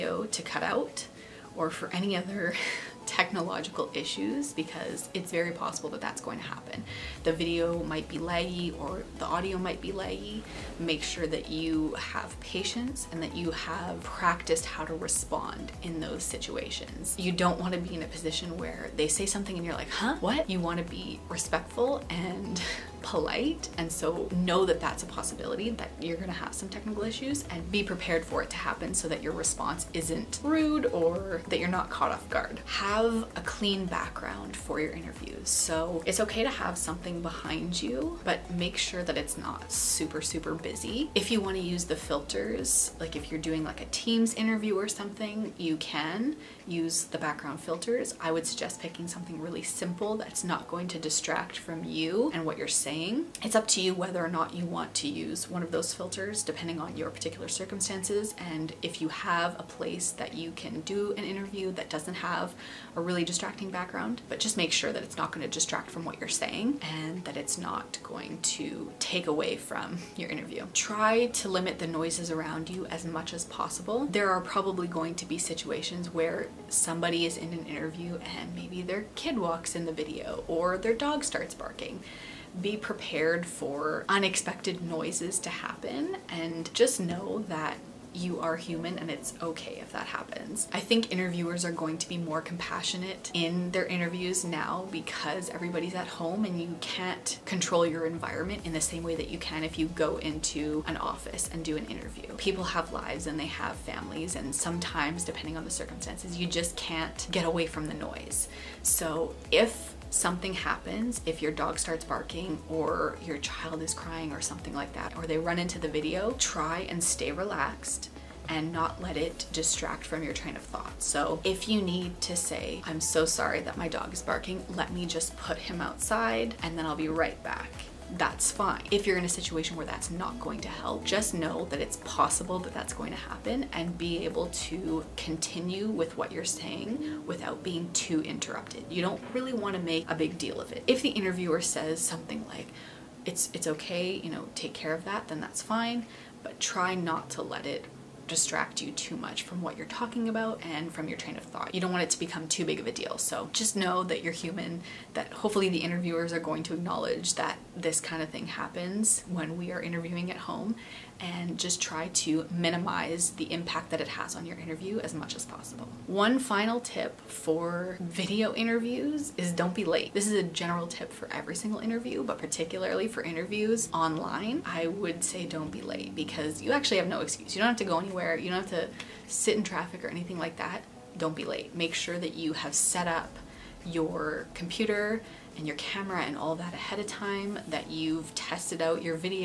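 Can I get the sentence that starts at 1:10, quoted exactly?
Try to limit the noises around you as much as possible.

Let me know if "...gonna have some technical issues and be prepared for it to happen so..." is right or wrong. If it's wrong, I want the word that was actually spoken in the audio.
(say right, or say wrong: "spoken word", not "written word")
right.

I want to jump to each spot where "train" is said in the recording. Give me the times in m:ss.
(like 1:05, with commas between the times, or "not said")
2:00, 2:31.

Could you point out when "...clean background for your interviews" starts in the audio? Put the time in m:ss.
0:33.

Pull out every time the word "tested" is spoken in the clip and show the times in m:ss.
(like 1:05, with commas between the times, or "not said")
3:08.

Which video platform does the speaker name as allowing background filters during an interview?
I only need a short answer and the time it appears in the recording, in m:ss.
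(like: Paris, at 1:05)
Teams, at 0:43.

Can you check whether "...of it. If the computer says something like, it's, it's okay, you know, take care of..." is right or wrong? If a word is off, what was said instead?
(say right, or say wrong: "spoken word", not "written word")
wrong: "interviewer", not "computer".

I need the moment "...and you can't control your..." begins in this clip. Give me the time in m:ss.
1:36.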